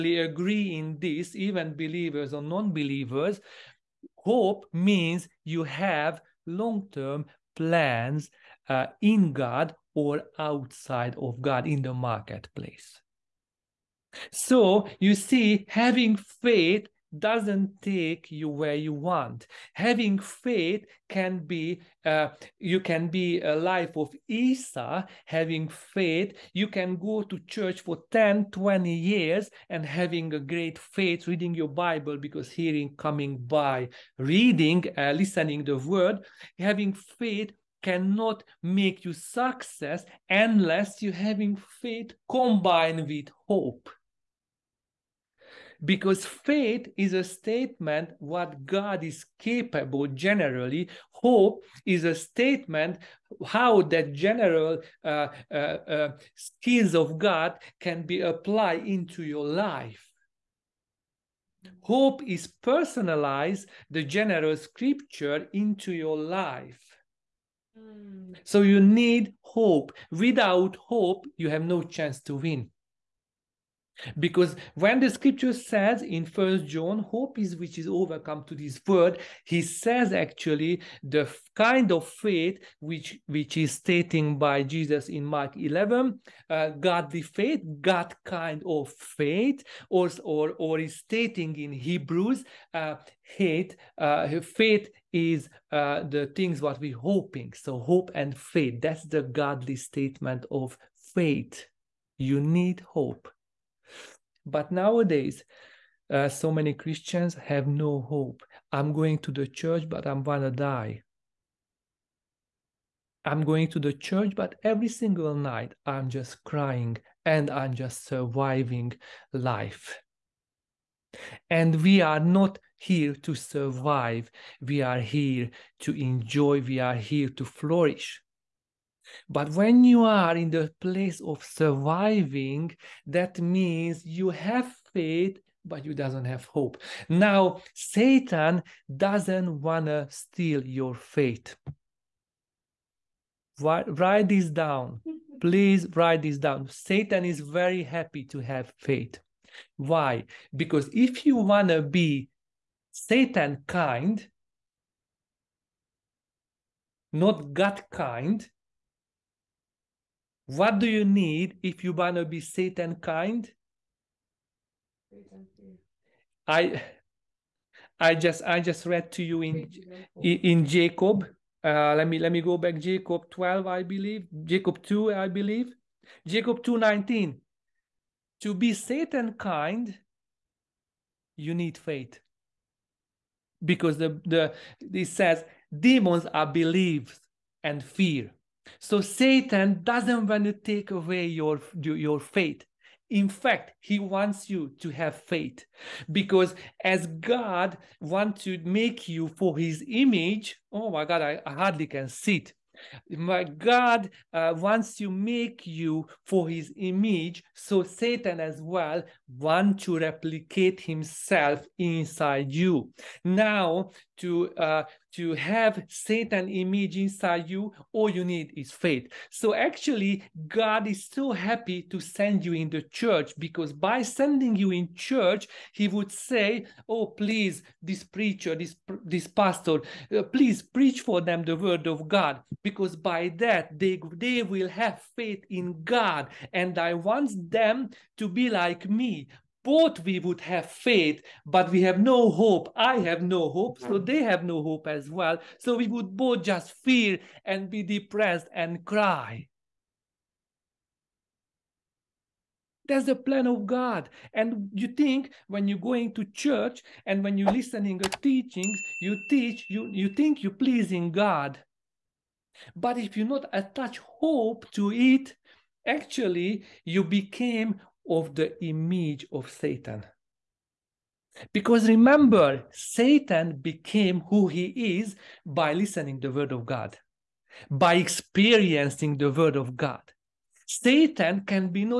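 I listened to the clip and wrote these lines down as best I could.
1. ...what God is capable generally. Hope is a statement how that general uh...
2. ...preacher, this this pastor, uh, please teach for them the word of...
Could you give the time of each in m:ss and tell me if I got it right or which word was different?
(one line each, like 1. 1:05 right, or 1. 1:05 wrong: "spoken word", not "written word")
1. 0:48 right
2. 3:48 wrong: "preach", not "teach".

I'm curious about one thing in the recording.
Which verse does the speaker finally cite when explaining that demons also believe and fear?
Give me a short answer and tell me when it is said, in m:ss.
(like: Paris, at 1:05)
Jacob 2:19, at 2:56.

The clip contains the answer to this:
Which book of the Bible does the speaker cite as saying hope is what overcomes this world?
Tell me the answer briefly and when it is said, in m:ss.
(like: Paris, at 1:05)
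First John, at 1:16.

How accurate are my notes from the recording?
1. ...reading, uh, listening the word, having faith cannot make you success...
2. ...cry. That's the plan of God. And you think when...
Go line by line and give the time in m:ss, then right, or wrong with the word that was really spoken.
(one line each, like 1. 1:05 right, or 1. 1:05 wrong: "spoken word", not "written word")
1. 0:34 right
2. 4:08 right.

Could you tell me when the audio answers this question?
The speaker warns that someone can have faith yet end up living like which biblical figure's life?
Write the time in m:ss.
0:24.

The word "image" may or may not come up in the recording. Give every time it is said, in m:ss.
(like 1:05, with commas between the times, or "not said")
3:19, 3:26, 3:36, 4:28.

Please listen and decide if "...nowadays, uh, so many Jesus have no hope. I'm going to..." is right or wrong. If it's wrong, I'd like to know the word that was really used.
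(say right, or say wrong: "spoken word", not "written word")
wrong: "Christians", not "Jesus".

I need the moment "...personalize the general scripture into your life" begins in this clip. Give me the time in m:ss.
1:02.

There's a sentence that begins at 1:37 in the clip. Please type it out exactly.
So hope and faith, that's the godly statement of faith.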